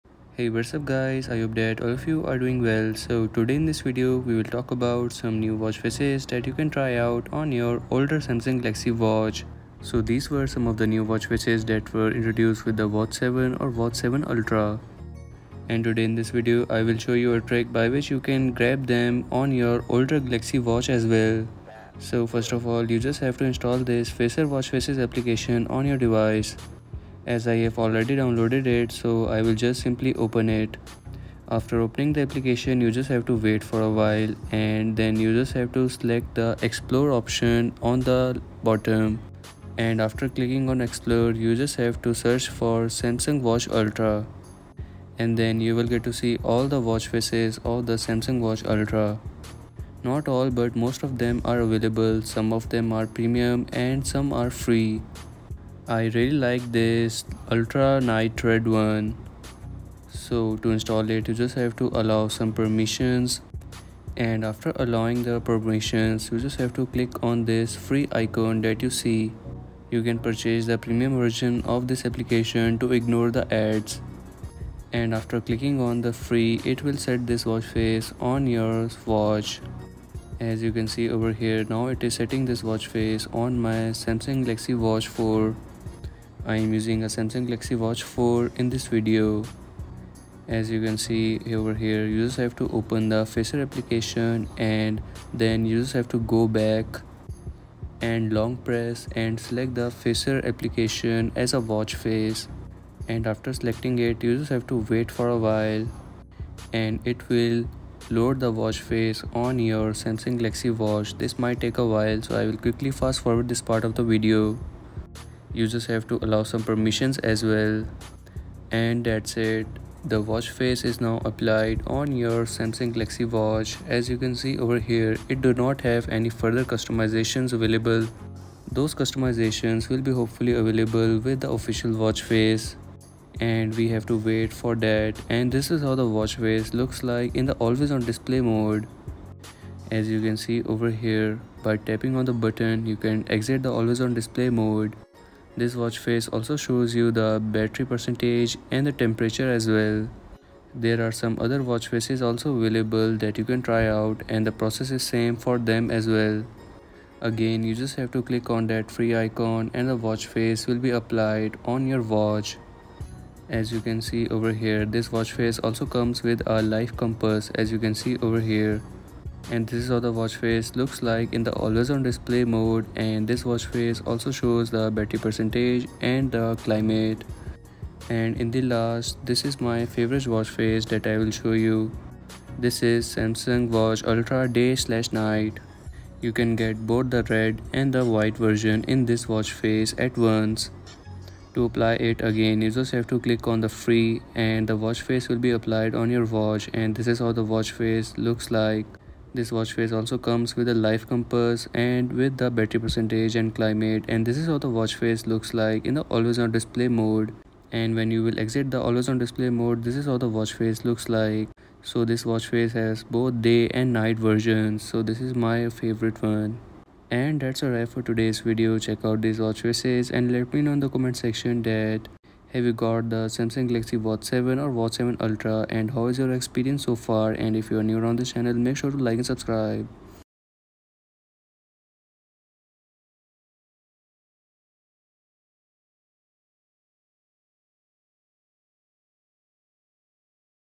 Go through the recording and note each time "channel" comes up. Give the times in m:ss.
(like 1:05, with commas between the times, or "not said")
3:48.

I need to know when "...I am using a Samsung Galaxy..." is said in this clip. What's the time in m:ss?
1:26.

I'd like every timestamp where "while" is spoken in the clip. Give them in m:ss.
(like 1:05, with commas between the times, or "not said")
0:33, 1:45, 1:51.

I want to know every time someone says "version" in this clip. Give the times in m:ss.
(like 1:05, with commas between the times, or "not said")
1:11, 3:08, 3:34.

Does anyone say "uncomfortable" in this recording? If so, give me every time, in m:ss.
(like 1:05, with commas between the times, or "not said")
not said.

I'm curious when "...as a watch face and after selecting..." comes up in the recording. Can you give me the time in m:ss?
1:41.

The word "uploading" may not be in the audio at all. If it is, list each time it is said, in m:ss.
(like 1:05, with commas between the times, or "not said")
not said.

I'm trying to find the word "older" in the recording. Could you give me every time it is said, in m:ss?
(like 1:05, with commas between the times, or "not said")
0:07, 0:19.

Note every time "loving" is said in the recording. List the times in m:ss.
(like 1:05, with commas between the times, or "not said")
not said.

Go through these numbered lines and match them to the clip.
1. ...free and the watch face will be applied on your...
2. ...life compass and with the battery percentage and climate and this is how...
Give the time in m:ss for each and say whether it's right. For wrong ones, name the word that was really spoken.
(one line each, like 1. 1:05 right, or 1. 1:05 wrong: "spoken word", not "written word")
1. 3:13 right
2. 3:20 right.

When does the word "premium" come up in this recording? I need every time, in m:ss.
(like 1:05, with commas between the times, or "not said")
0:53, 1:10.